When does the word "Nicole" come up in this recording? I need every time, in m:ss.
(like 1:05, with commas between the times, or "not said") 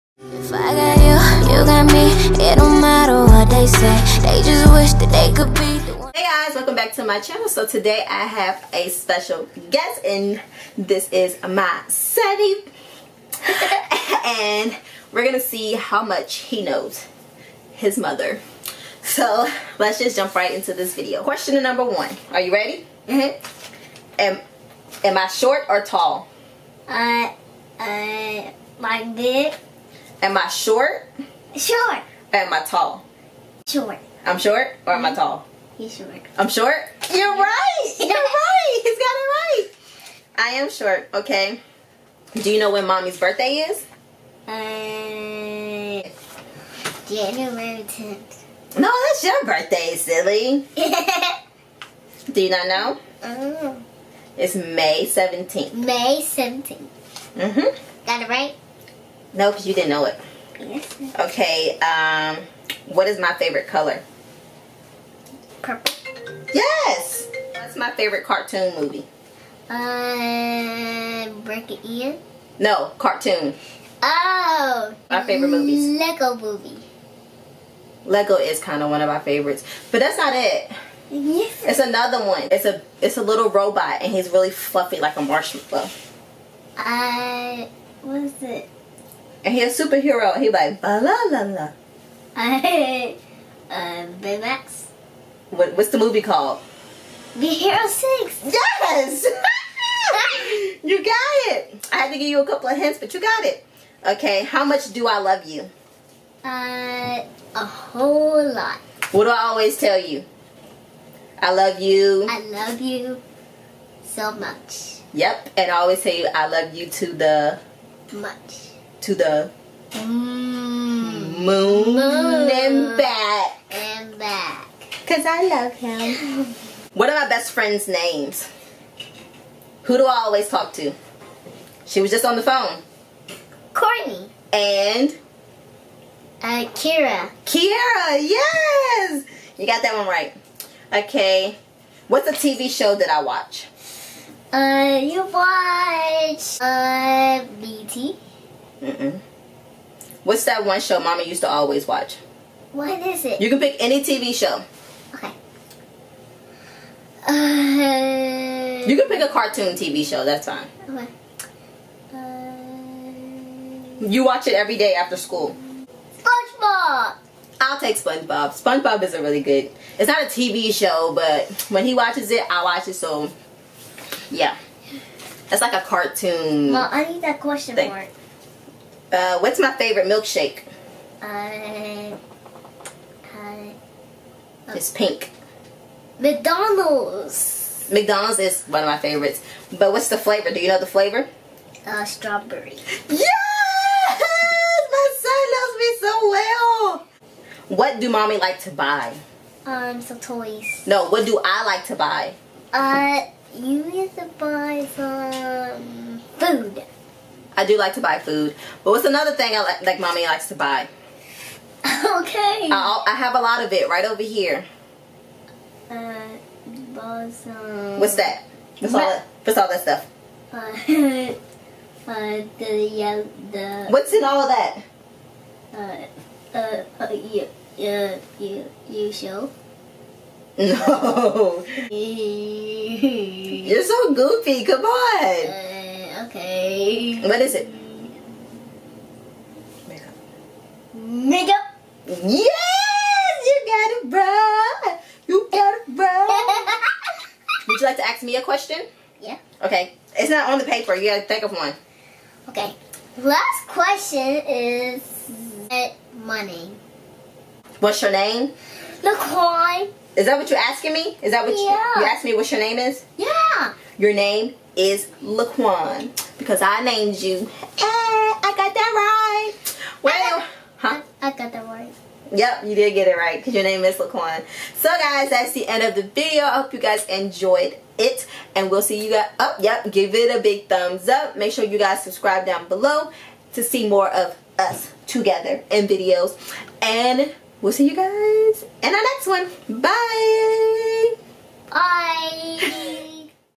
4:19.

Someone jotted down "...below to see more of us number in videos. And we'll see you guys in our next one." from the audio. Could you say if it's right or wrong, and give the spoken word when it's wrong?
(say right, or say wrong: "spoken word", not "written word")
wrong: "together", not "number".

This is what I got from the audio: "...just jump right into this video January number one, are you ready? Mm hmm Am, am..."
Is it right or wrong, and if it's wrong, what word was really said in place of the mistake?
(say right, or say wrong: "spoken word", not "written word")
wrong: "Question", not "January".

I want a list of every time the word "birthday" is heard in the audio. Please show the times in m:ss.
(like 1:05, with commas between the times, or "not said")
0:43, 0:49.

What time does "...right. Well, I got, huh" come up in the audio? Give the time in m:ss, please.
4:28.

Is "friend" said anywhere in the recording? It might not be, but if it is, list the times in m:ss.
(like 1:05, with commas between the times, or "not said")
2:07.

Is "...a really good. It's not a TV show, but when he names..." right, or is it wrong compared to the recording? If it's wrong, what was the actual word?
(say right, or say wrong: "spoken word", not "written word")
wrong: "watches", not "names".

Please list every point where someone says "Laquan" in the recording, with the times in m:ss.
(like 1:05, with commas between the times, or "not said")
4:25, 4:33.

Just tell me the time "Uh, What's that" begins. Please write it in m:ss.
3:35.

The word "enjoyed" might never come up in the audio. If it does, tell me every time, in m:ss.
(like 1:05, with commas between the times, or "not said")
4:37.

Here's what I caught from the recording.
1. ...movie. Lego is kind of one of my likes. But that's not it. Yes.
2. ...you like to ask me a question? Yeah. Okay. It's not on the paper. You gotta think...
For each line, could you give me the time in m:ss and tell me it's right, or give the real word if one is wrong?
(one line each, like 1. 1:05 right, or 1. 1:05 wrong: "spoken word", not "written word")
1. 1:16 wrong: "favorites", not "likes"
2. 4:07 right.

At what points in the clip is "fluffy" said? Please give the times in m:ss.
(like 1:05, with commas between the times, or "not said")
1:24.